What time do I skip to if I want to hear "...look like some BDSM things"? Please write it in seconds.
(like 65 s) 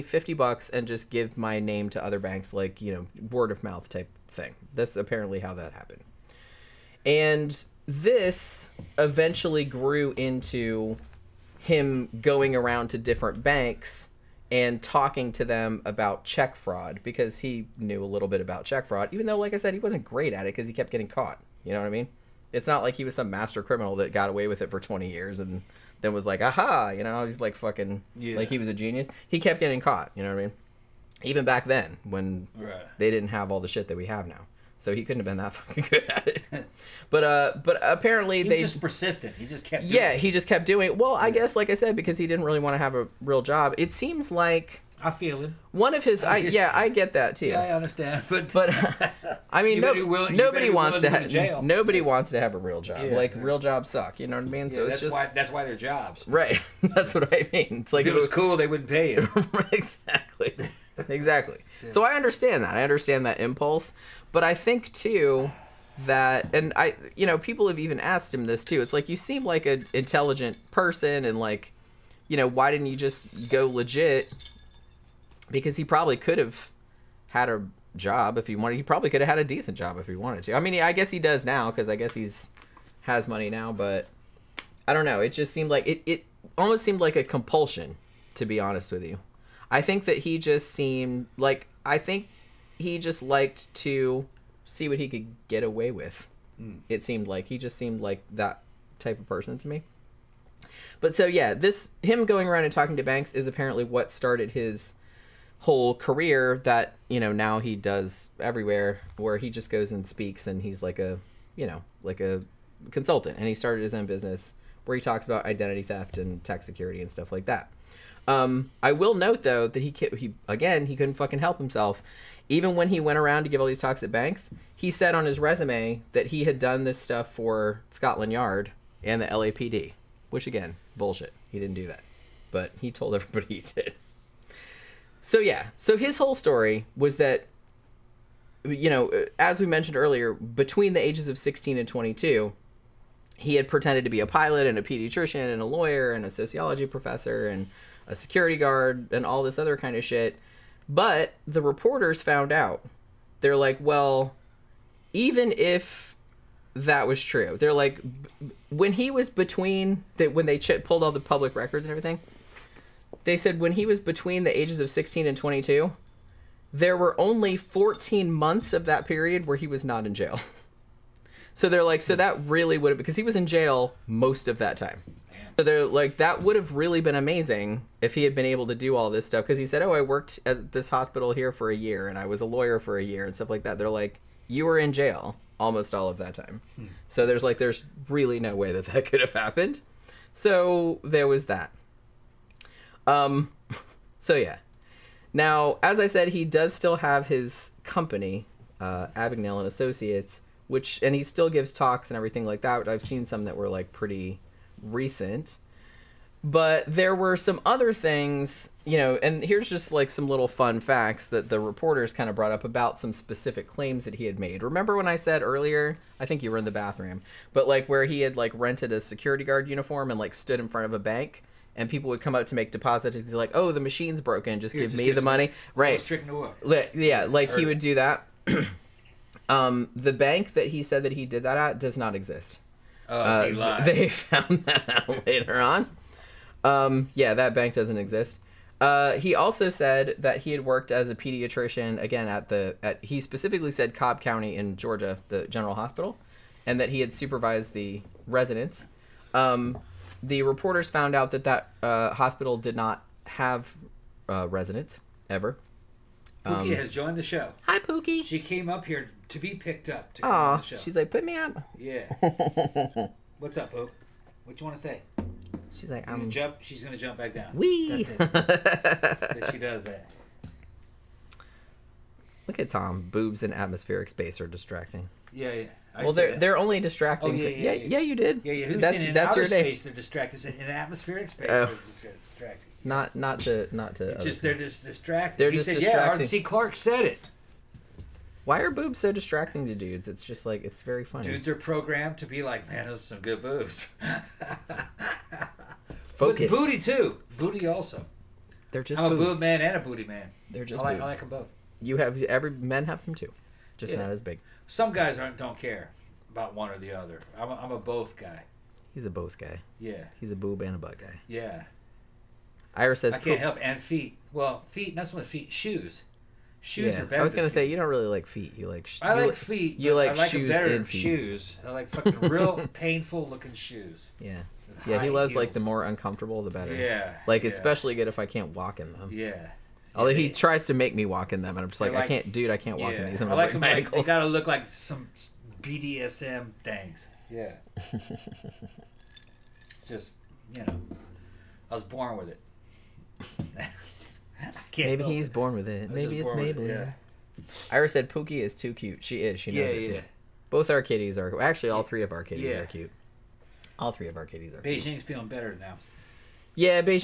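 334 s.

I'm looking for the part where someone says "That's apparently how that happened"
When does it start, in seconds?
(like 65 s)
4 s.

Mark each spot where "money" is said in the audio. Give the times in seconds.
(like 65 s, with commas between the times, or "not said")
83 s, 225 s.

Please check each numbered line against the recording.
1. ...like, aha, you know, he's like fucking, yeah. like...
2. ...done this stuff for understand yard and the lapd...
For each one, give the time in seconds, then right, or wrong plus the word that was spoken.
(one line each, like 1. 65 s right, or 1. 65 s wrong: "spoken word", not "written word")
1. 26 s right
2. 126 s wrong: "scotland", not "understand".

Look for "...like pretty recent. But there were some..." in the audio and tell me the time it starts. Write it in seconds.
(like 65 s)
203 s.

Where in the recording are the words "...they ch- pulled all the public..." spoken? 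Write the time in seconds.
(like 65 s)
160 s.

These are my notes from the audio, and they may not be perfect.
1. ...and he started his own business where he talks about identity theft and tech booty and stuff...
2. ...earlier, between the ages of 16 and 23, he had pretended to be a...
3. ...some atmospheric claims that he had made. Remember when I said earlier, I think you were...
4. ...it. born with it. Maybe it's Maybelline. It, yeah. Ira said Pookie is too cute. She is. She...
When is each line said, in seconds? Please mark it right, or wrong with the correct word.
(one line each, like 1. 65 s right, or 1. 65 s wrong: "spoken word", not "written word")
1. 113 s wrong: "security", not "booty"
2. 139 s wrong: "22", not "23"
3. 212 s wrong: "specific", not "atmospheric"
4. 345 s right.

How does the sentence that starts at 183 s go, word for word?
They're like, you were in jail almost all of that time.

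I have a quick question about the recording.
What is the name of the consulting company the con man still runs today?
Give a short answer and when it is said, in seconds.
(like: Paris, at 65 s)
Abagnale and Associates, at 199 s.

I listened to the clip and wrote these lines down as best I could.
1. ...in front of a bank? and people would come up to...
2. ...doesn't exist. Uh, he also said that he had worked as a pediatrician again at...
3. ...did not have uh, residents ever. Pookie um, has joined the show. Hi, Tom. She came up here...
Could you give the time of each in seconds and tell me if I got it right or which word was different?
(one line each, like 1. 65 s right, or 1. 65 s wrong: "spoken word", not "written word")
1. 220 s right
2. 237 s right
3. 252 s wrong: "Pookie", not "Tom".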